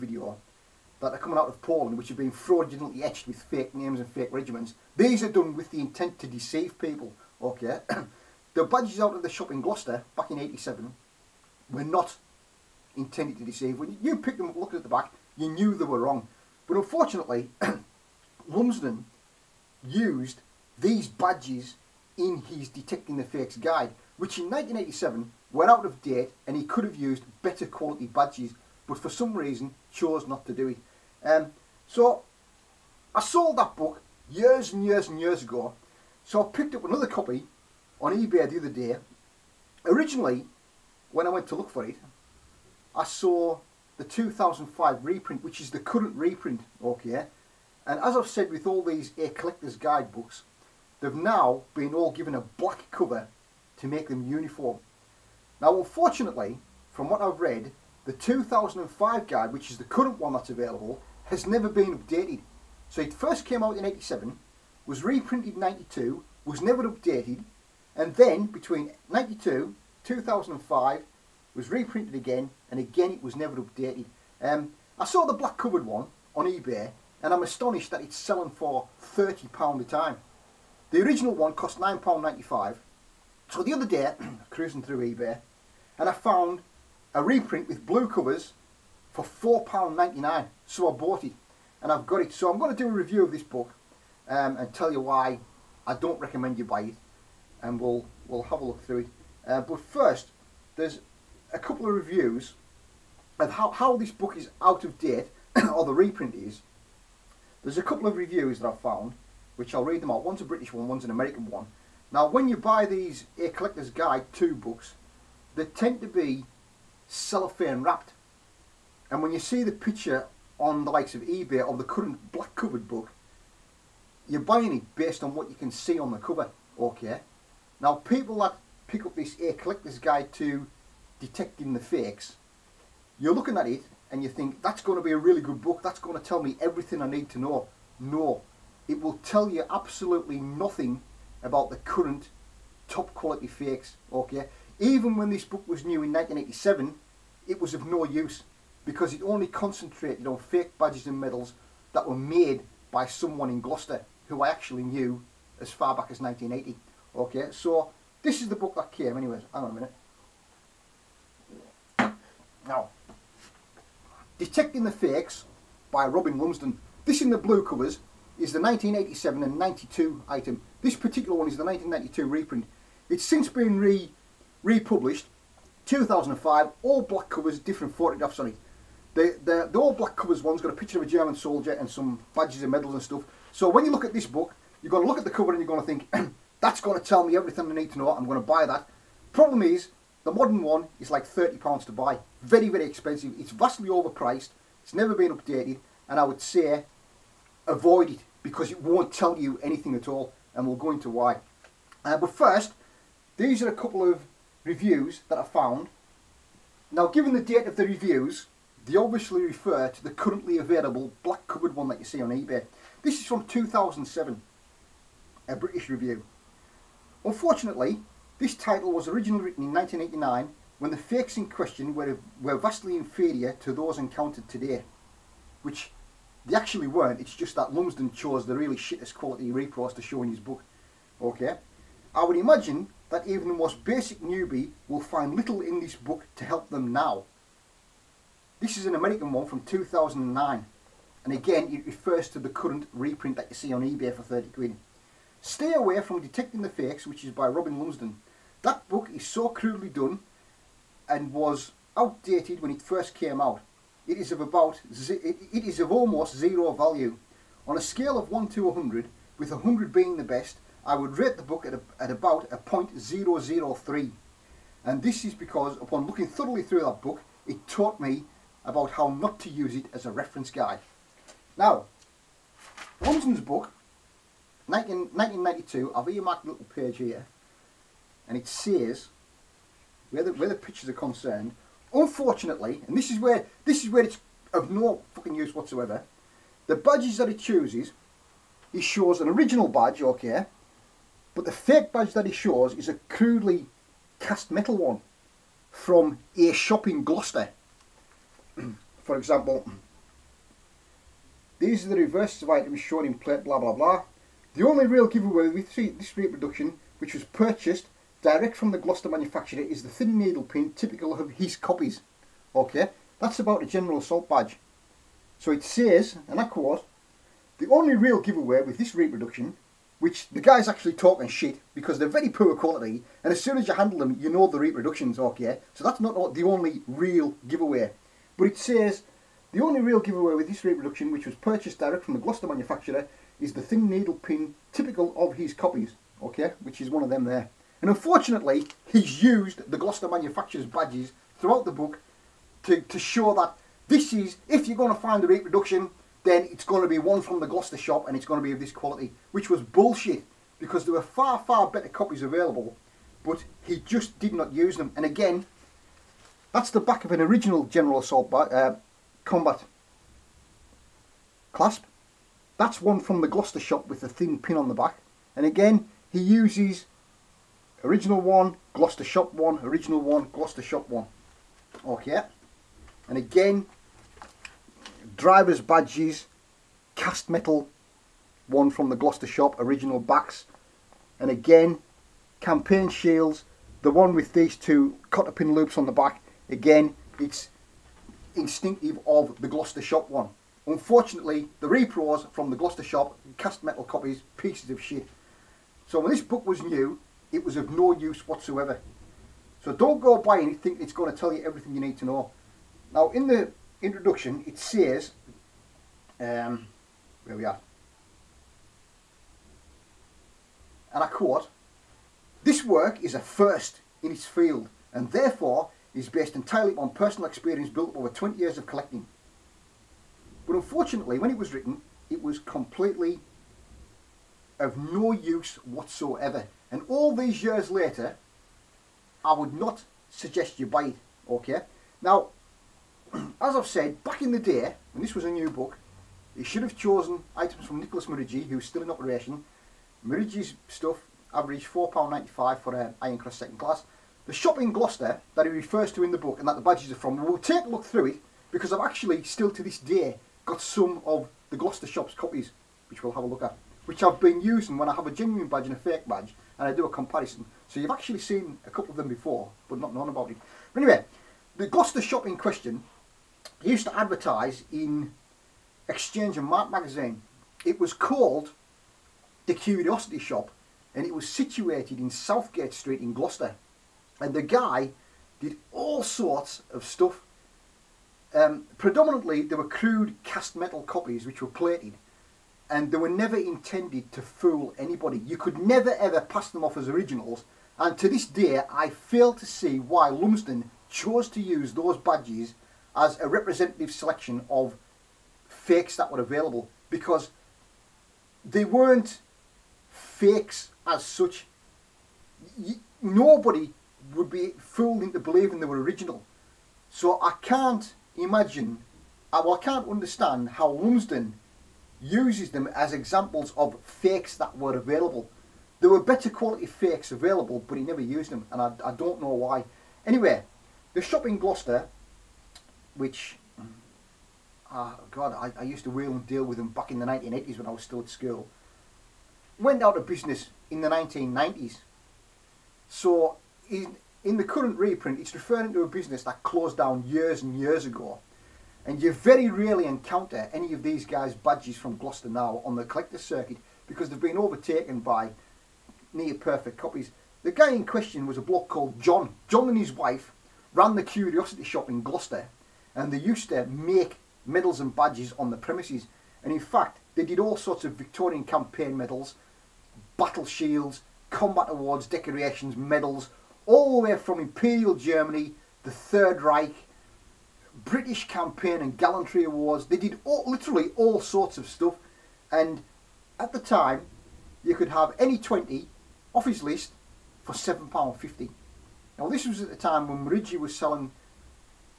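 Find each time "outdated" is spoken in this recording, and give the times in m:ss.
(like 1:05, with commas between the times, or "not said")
4:11.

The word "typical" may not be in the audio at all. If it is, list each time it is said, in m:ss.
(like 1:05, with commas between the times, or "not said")
5:10, 5:34.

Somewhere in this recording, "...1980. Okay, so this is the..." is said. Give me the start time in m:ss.
2:36.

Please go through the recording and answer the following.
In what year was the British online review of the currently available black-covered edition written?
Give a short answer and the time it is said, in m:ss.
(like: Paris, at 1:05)
2007, at 3:33.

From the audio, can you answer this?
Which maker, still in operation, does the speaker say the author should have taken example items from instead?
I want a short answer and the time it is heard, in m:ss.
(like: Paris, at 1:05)
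Nicholas Murigi, at 7:17.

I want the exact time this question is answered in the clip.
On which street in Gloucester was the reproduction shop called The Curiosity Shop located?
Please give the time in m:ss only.
7:52.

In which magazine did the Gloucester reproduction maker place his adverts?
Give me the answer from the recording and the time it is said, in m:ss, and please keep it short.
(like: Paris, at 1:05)
Exchange and Mart, at 7:45.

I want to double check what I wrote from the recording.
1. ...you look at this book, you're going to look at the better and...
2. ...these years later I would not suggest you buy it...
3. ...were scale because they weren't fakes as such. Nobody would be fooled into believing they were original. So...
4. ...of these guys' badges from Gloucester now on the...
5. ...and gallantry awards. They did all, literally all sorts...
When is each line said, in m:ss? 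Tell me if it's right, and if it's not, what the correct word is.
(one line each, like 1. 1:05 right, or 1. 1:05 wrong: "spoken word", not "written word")
1. 3:03 wrong: "cover", not "better"
2. 7:07 right
3. 8:16 wrong: "available", not "scale"
4. 9:00 right
5. 9:28 right.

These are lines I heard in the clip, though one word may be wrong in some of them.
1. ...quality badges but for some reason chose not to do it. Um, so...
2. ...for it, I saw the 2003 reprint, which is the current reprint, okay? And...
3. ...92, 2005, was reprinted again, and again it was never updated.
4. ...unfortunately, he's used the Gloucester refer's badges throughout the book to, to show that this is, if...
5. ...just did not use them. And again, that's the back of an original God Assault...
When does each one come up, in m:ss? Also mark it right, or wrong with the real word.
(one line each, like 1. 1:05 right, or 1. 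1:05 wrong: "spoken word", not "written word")
1. 0:27 right
2. 0:41 wrong: "2005", not "2003"
3. 1:09 right
4. 5:37 wrong: "manufacturer", not "refer"
5. 5:53 wrong: "General", not "God".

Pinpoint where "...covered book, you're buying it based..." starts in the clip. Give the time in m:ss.
2:02.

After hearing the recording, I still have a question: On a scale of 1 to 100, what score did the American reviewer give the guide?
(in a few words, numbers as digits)
0.003.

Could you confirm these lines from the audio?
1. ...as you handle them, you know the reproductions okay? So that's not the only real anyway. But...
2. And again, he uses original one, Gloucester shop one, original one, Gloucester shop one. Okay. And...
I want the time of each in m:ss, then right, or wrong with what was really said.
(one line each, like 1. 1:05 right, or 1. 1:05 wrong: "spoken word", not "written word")
1. 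5:23 wrong: "giveaway", not "anyway"
2. 6:05 right.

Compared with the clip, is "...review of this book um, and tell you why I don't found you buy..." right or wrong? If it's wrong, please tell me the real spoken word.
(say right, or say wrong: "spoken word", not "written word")
wrong: "recommend", not "found".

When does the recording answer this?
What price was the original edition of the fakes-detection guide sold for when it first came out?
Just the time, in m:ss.
1:21.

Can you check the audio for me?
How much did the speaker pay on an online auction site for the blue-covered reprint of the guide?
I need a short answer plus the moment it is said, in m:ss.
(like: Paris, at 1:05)
£4.99, at 1:29.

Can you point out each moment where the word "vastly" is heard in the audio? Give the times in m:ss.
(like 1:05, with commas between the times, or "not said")
3:13, 3:42.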